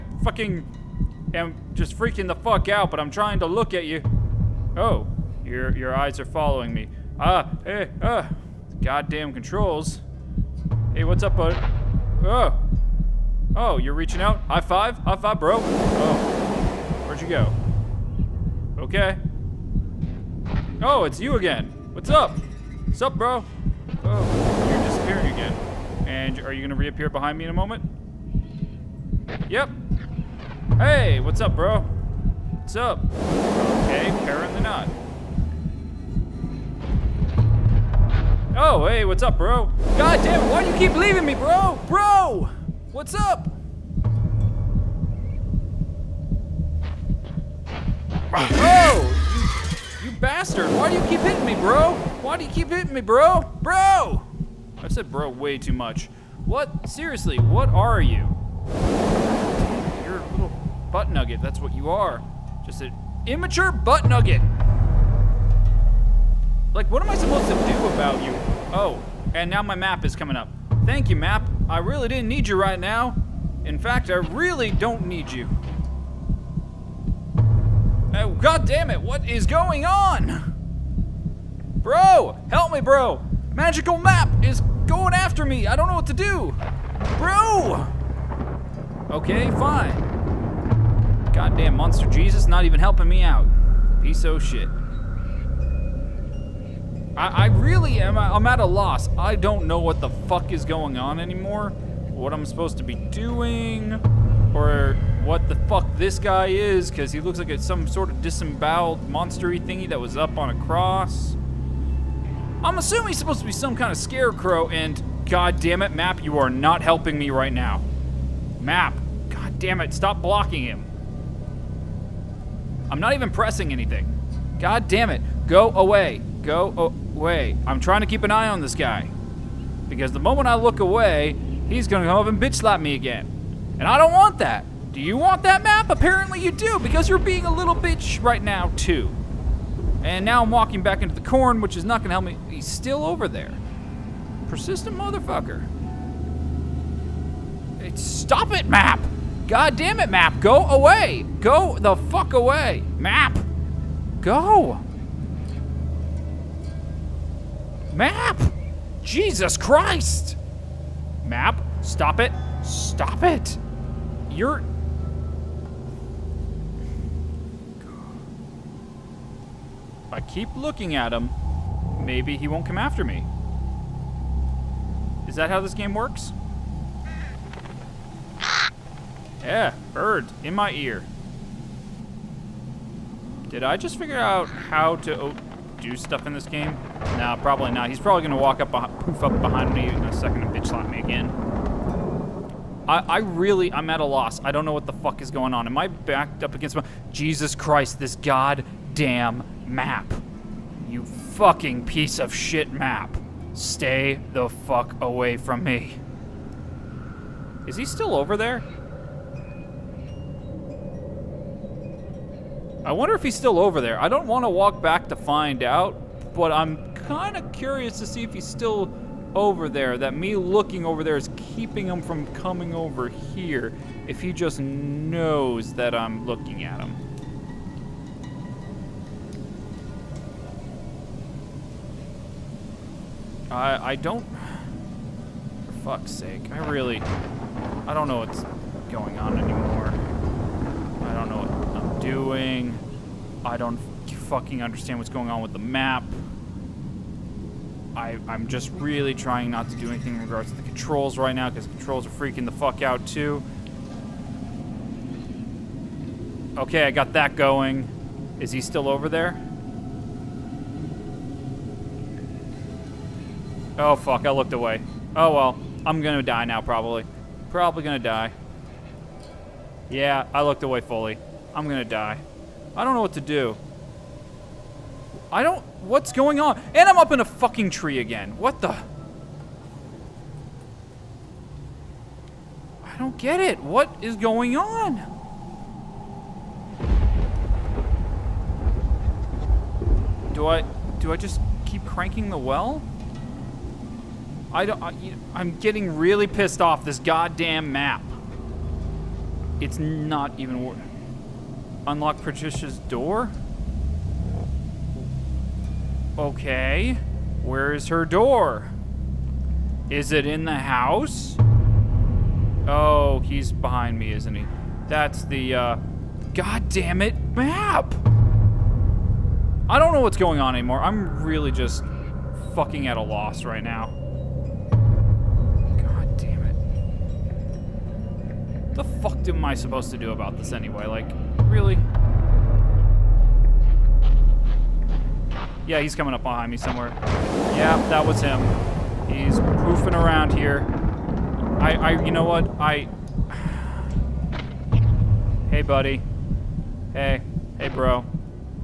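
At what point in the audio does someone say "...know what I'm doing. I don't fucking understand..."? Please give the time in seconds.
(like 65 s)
241 s.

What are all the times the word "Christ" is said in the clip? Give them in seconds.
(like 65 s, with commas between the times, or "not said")
159 s, 197 s.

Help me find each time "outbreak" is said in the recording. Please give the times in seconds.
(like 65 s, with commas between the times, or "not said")
not said.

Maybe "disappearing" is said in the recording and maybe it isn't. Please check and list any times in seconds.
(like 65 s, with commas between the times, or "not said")
24 s.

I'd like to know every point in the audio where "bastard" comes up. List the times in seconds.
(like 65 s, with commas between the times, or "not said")
50 s.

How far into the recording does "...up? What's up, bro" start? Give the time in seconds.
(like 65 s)
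22 s.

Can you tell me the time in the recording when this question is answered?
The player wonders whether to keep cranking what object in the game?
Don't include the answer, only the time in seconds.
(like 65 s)
292 s.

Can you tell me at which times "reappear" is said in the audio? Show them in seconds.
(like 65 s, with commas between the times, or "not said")
26 s.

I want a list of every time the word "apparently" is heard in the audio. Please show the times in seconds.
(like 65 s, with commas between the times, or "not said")
34 s, 135 s.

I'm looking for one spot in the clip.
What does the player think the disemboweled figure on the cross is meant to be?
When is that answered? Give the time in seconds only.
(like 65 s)
113 s.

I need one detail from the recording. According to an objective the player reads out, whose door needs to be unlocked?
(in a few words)
Patricia's.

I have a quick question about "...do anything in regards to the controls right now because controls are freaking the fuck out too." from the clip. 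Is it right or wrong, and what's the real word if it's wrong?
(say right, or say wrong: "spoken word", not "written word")
right.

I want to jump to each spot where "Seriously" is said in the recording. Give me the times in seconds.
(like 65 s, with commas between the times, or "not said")
56 s.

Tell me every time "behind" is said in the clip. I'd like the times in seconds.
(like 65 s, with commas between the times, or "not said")
27 s, 189 s, 313 s, 336 s.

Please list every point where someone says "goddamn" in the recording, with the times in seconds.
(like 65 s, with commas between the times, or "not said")
8 s, 91 s, 198 s, 297 s.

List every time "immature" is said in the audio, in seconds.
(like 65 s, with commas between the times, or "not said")
63 s.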